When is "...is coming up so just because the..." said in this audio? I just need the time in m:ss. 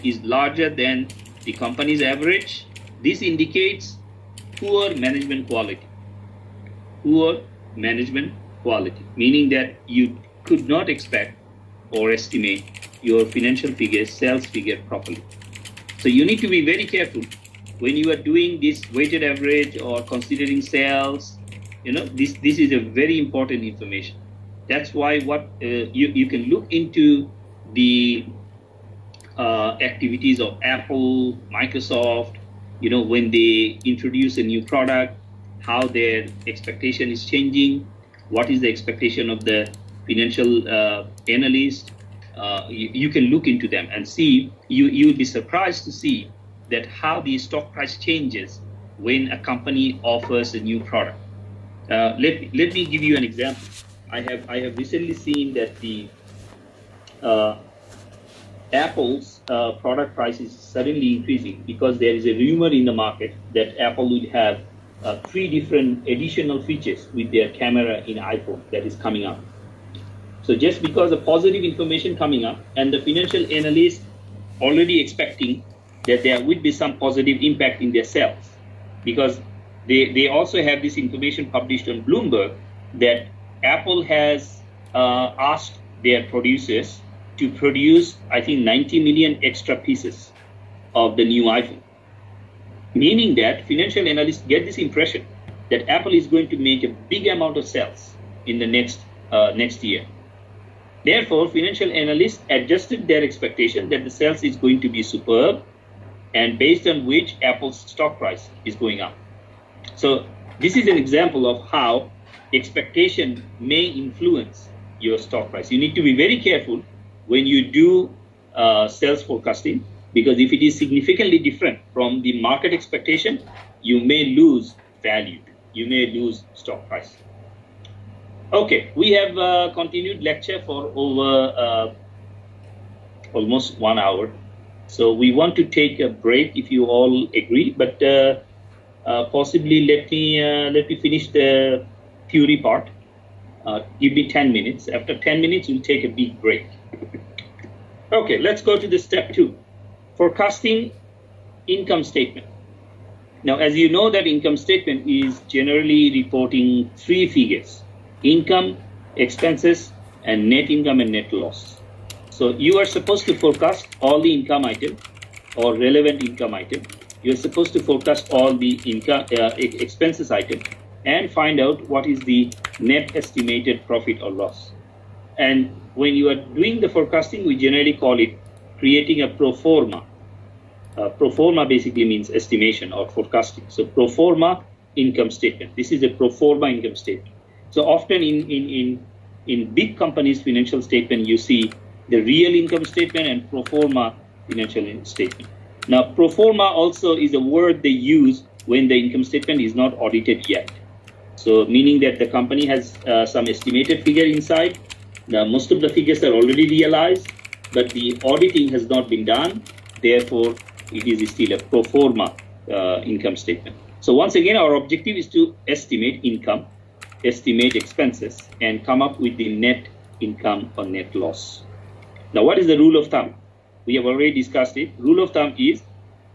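1:08.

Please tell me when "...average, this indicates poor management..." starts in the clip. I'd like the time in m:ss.
0:02.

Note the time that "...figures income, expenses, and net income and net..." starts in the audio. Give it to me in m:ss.
2:37.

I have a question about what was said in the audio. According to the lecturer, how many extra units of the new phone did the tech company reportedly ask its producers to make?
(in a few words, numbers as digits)
90 million.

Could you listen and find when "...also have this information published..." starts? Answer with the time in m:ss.
1:20.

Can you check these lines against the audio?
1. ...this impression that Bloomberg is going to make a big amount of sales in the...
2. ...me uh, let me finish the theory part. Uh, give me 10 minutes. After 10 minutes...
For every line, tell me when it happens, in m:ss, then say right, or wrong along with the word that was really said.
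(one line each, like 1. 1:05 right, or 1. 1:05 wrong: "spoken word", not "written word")
1. 1:34 wrong: "Apple", not "Bloomberg"
2. 2:20 right.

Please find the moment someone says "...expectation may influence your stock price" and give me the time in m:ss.
1:52.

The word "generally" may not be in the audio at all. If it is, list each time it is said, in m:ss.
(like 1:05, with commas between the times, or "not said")
2:35, 2:57.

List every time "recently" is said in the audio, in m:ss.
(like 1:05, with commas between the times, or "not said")
0:54.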